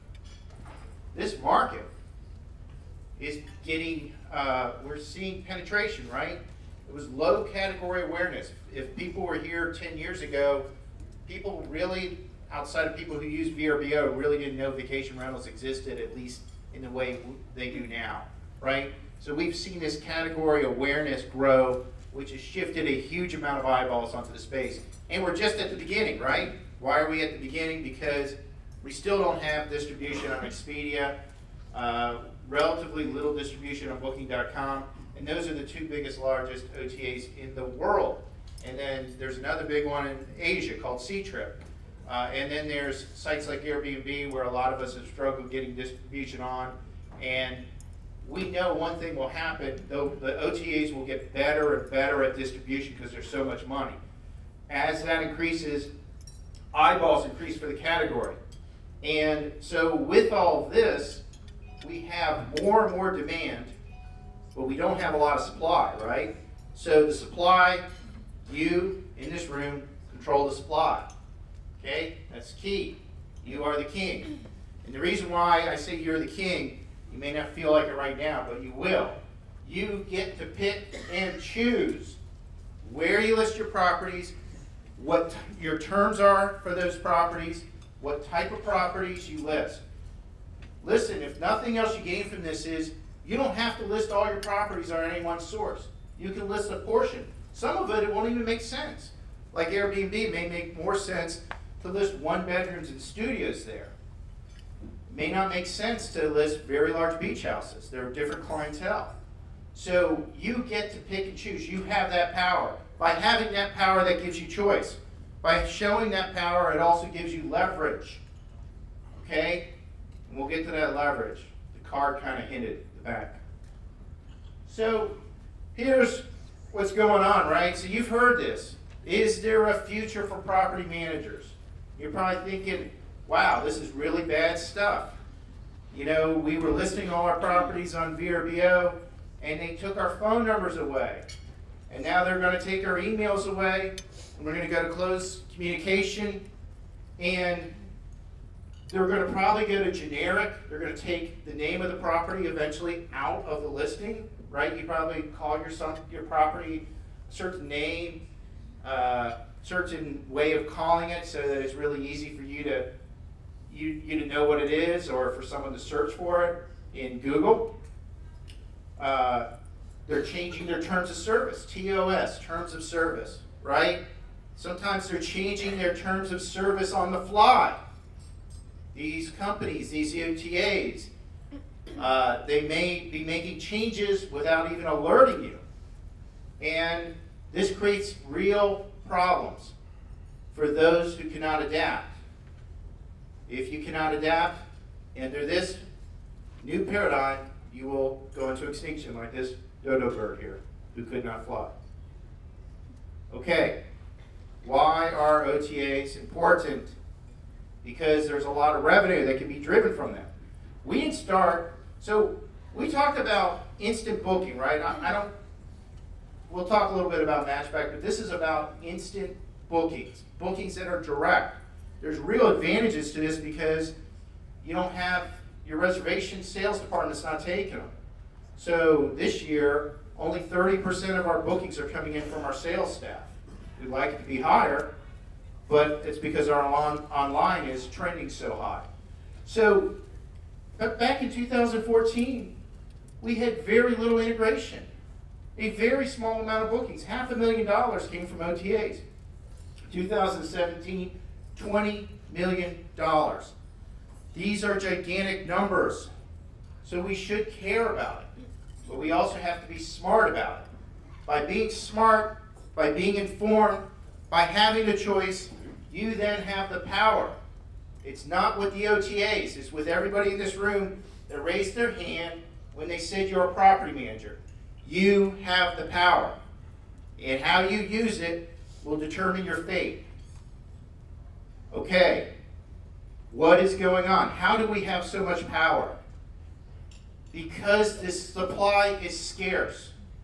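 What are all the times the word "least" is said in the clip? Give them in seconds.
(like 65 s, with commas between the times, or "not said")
16 s.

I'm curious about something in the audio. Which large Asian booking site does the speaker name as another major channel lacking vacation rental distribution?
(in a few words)
Ctrip.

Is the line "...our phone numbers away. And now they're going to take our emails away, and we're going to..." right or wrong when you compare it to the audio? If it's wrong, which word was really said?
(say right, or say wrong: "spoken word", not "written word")
right.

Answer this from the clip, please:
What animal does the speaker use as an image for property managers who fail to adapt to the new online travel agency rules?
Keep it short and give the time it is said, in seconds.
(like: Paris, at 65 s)
dodo bird, at 199 s.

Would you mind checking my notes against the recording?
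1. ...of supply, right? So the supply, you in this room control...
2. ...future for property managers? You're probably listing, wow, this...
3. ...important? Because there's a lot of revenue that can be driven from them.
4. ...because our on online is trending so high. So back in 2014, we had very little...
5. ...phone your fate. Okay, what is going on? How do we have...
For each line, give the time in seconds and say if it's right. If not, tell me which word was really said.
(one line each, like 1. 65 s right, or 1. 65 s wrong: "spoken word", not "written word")
1. 65 s right
2. 129 s wrong: "thinking", not "listing"
3. 206 s right
4. 236 s right
5. 278 s wrong: "determine", not "phone".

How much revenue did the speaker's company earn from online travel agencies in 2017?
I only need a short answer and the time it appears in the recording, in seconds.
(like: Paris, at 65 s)
$20 million, at 251 s.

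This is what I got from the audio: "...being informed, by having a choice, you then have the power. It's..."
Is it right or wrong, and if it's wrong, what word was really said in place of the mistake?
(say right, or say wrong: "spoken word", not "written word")
right.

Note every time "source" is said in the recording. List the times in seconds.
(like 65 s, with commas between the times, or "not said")
95 s.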